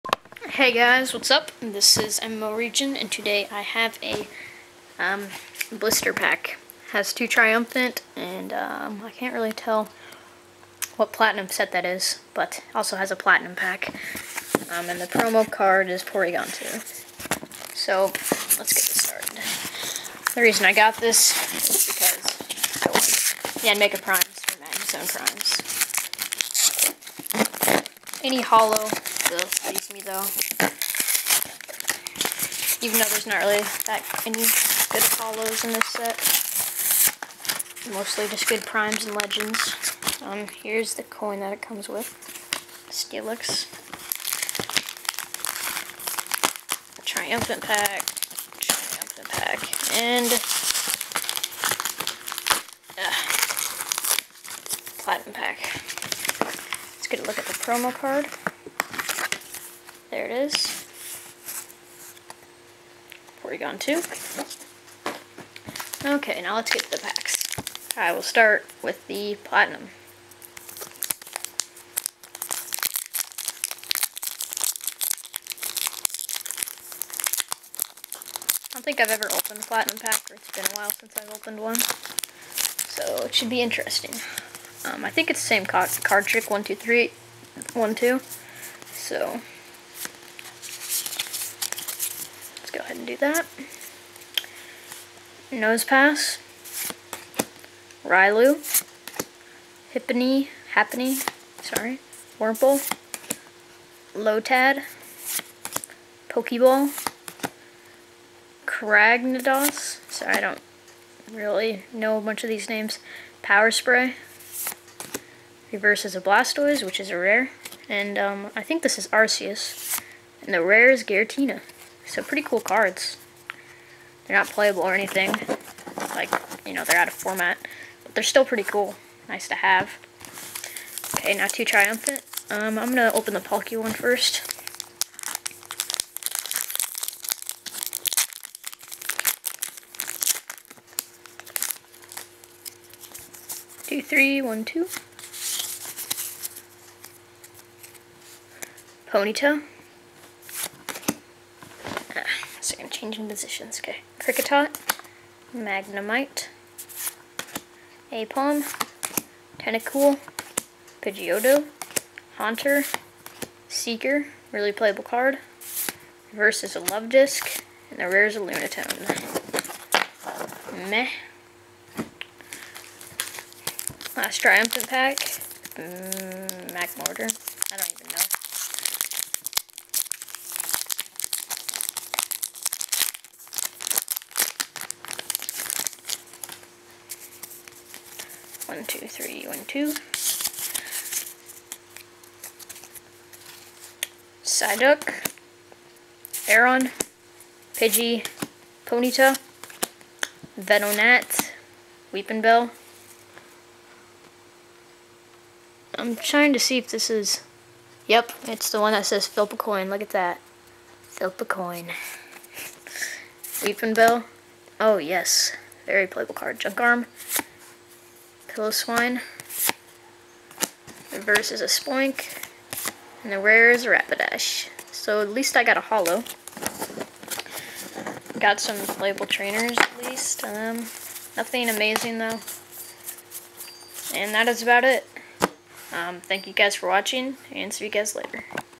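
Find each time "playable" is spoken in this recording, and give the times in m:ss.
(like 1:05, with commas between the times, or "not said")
2:04, 2:44, 3:36.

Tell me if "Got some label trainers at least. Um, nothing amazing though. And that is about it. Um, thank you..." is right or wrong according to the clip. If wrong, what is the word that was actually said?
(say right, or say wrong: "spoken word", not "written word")
right.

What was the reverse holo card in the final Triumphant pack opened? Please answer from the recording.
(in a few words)
Spoink.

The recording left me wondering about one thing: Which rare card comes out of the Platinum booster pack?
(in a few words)
Giratina.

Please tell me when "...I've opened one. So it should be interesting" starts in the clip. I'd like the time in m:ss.
1:21.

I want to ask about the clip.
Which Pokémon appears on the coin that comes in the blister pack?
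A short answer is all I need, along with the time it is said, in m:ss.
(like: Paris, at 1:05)
Steelix, at 0:42.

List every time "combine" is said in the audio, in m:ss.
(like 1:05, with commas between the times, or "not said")
not said.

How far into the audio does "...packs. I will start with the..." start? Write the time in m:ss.
1:06.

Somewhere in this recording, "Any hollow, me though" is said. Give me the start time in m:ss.
0:28.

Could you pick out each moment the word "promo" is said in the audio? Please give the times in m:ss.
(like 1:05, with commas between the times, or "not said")
0:15, 0:57.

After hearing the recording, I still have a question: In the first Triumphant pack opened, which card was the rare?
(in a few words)
Lunatone.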